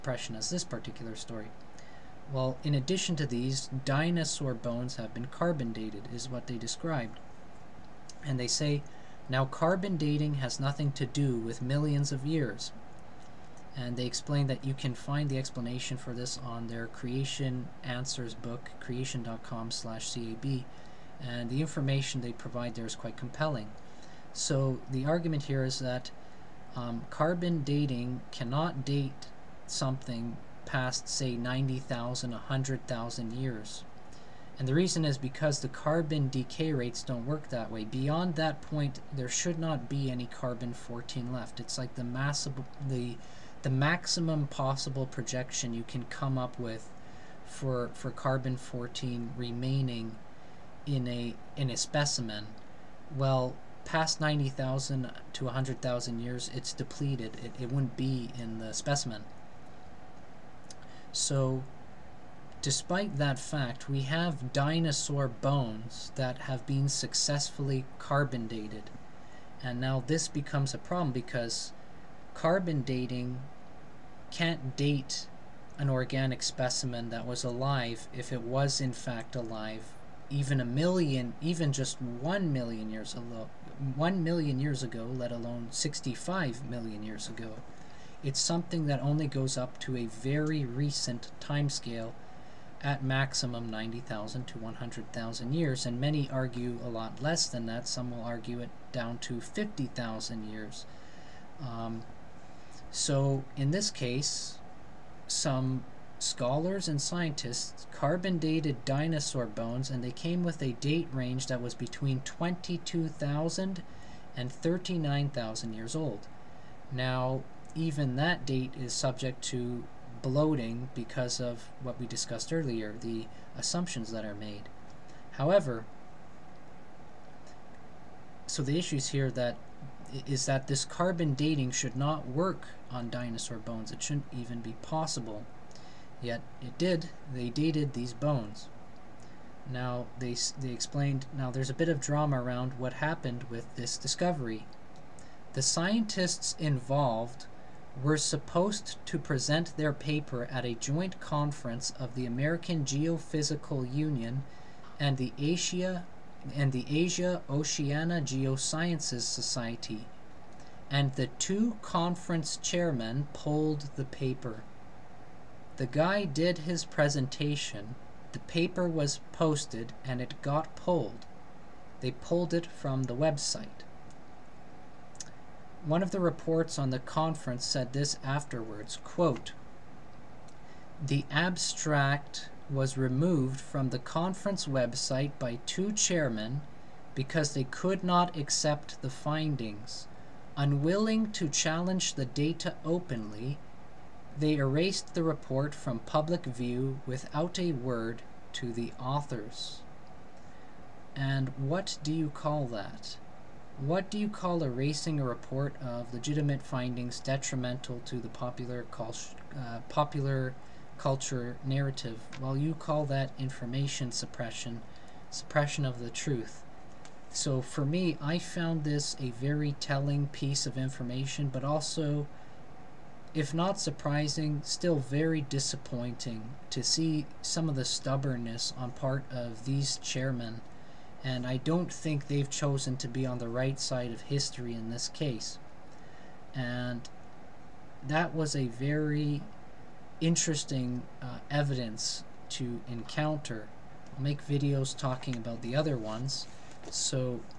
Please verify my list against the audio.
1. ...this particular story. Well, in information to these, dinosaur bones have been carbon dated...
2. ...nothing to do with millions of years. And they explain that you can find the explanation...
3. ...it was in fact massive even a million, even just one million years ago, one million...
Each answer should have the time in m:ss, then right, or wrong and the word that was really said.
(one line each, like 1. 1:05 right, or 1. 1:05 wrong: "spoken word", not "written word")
1. 0:00 wrong: "addition", not "information"
2. 0:10 right
3. 1:18 wrong: "alive", not "massive".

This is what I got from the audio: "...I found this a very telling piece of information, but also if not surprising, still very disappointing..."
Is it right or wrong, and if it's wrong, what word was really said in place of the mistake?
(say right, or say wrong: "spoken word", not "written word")
right.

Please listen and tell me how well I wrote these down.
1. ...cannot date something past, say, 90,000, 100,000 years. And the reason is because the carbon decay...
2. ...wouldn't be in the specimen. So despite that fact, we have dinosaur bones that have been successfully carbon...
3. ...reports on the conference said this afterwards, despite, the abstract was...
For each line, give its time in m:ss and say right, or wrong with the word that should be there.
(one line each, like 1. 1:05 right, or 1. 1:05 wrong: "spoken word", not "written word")
1. 0:28 right
2. 0:57 right
3. 2:56 wrong: "quote", not "despite".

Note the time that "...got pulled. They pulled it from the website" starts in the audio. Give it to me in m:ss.
2:50.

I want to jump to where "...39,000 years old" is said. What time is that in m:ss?
1:54.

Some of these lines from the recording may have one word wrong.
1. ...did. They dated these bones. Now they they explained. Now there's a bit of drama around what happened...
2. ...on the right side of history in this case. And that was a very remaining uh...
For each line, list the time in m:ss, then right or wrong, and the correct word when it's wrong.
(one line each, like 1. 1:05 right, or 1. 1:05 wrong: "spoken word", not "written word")
1. 2:16 right
2. 3:53 wrong: "interesting", not "remaining".